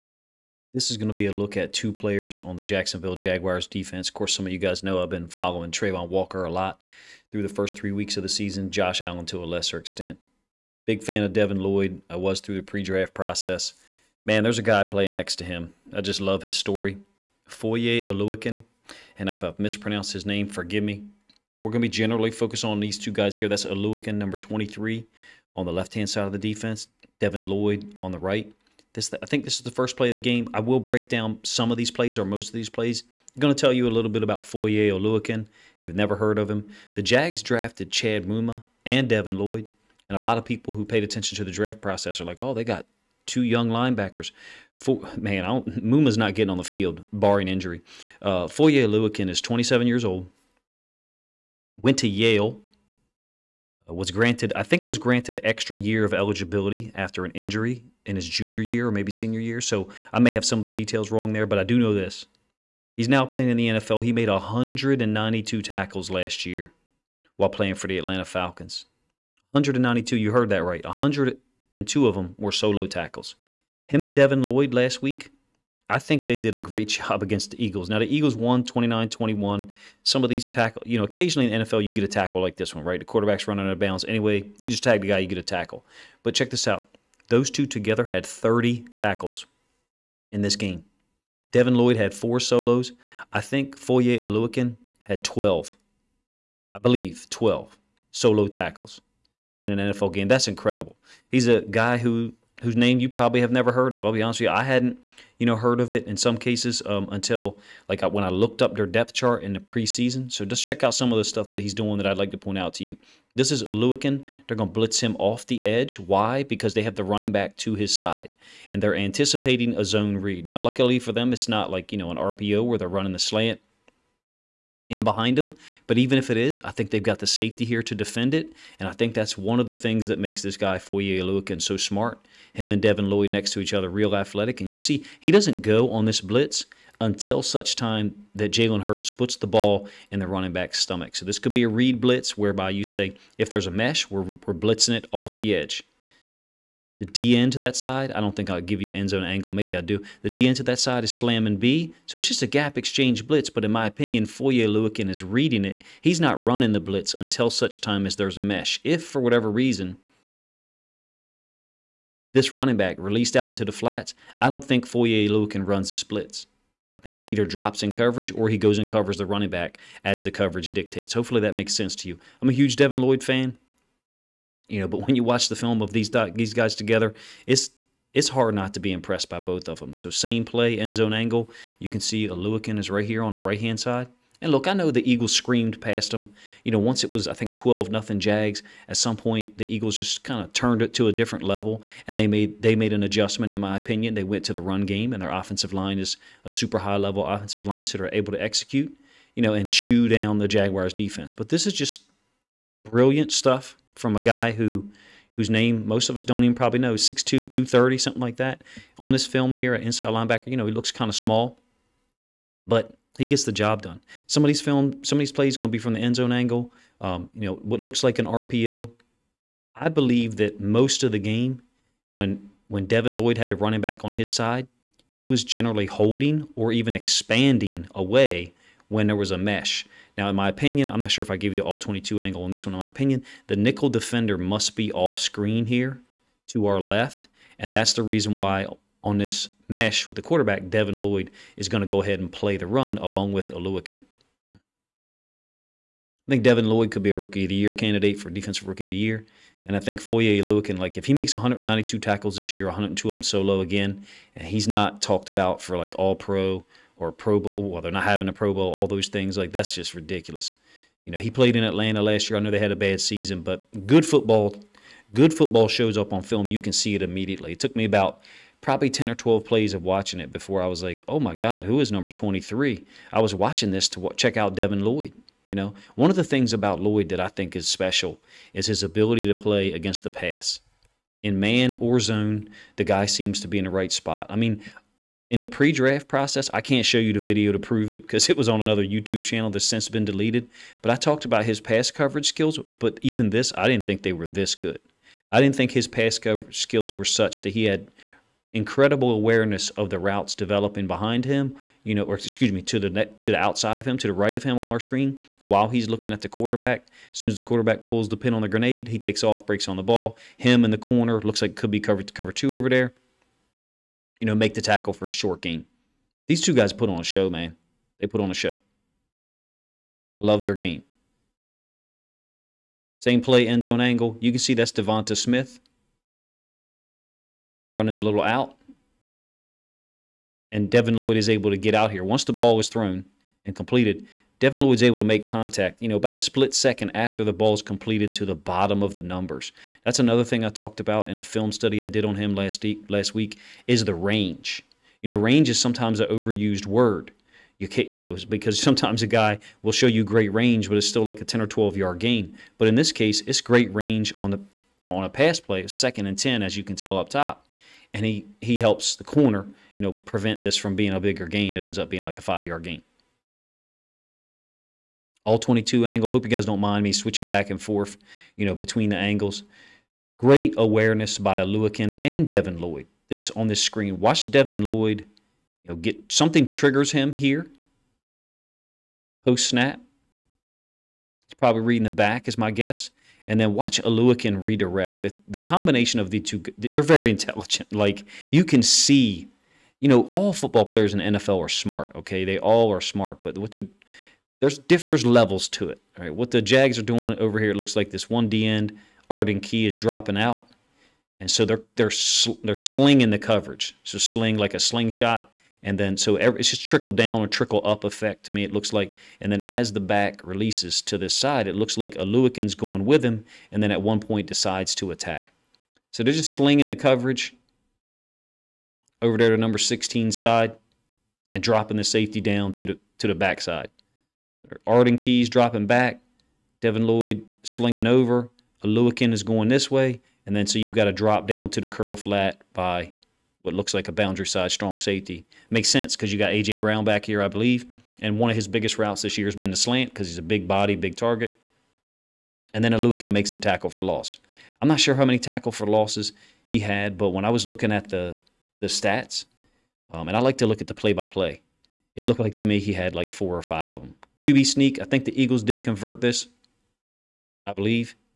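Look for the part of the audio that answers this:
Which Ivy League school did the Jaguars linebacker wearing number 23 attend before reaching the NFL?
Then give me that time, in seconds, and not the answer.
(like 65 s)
52 s.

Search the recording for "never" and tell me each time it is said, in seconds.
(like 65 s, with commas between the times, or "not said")
35 s, 103 s.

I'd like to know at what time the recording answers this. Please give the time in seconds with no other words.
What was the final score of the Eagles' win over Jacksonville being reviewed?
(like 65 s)
78 s.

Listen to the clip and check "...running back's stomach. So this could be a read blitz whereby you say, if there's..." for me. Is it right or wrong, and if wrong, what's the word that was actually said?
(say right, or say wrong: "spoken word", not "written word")
right.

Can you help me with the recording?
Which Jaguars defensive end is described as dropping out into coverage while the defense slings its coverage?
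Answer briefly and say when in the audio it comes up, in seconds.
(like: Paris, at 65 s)
Arden Key, at 399 s.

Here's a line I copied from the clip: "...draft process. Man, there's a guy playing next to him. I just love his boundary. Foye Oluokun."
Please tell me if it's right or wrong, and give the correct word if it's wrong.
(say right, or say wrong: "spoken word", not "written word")
wrong: "story", not "boundary".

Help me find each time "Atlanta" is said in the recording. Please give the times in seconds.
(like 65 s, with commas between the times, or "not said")
67 s, 261 s.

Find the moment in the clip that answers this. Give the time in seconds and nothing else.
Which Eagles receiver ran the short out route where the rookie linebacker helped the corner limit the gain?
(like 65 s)
324 s.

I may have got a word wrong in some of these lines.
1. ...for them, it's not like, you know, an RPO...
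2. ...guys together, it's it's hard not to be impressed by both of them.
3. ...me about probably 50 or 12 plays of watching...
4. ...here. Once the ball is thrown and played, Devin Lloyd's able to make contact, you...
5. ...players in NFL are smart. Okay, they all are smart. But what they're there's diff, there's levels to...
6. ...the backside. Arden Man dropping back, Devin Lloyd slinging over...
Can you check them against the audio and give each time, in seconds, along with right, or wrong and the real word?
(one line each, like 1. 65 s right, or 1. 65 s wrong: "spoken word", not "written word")
1. 120 s right
2. 176 s right
3. 267 s wrong: "10", not "50"
4. 331 s wrong: "completed", not "played"
5. 390 s right
6. 423 s wrong: "Keys", not "Man".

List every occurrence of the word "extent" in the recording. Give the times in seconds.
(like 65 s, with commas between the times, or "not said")
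9 s.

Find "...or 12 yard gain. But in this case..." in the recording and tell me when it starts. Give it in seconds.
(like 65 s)
351 s.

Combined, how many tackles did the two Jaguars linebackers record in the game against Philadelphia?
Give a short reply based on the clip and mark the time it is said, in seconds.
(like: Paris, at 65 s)
30, at 88 s.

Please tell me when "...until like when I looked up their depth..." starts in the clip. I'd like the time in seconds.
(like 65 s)
107 s.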